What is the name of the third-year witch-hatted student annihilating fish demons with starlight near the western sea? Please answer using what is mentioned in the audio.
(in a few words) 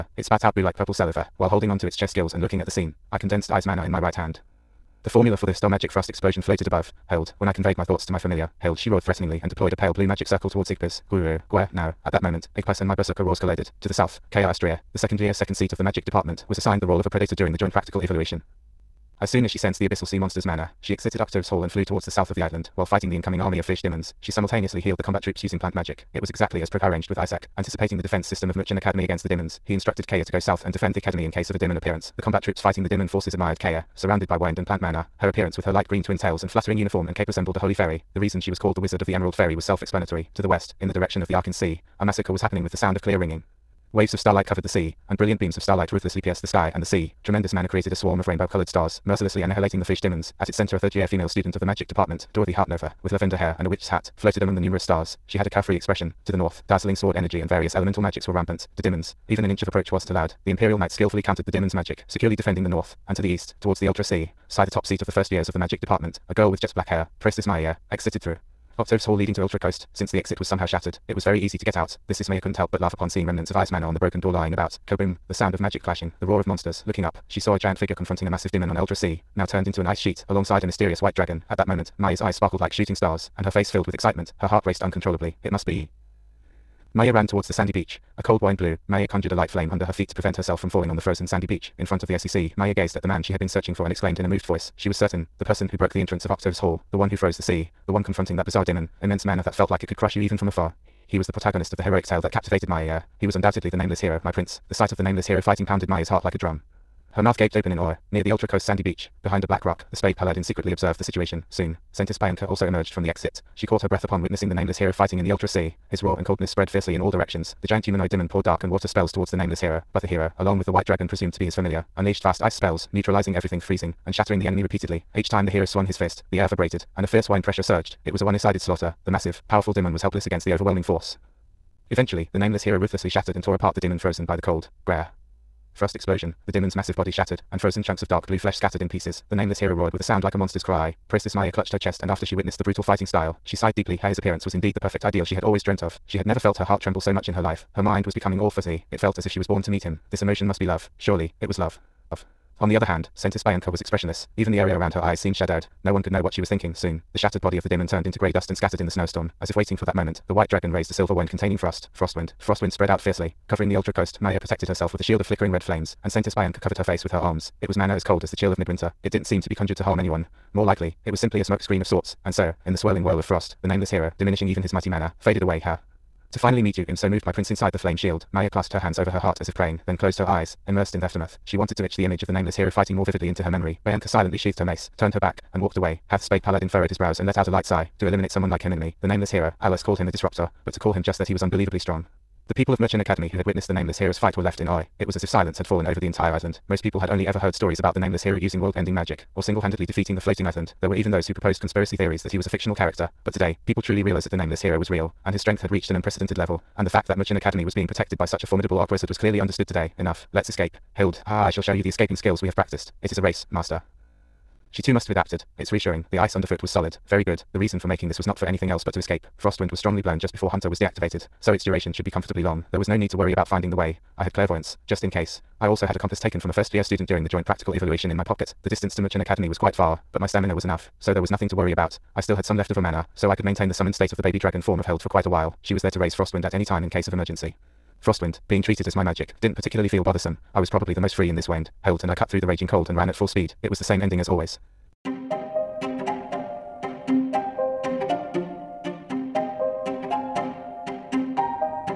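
Dorothy Hartnova.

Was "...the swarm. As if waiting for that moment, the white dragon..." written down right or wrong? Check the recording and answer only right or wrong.
wrong.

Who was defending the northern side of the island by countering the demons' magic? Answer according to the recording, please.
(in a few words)
The Imperial Knights.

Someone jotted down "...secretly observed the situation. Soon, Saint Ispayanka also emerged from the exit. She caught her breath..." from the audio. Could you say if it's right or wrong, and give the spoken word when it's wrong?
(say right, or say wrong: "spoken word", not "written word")
right.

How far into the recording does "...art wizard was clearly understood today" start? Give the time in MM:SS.
03:28.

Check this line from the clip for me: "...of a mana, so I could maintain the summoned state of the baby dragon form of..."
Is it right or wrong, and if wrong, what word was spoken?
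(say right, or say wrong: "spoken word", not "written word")
right.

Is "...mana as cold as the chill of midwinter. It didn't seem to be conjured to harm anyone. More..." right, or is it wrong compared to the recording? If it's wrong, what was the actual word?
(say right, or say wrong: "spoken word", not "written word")
right.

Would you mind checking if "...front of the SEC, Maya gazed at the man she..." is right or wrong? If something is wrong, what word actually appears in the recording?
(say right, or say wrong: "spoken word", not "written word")
right.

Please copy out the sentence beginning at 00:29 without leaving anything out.
He instructed Kaya to go south and defend the academy in case of a demon appearance.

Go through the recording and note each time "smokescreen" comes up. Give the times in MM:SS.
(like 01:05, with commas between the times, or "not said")
02:51.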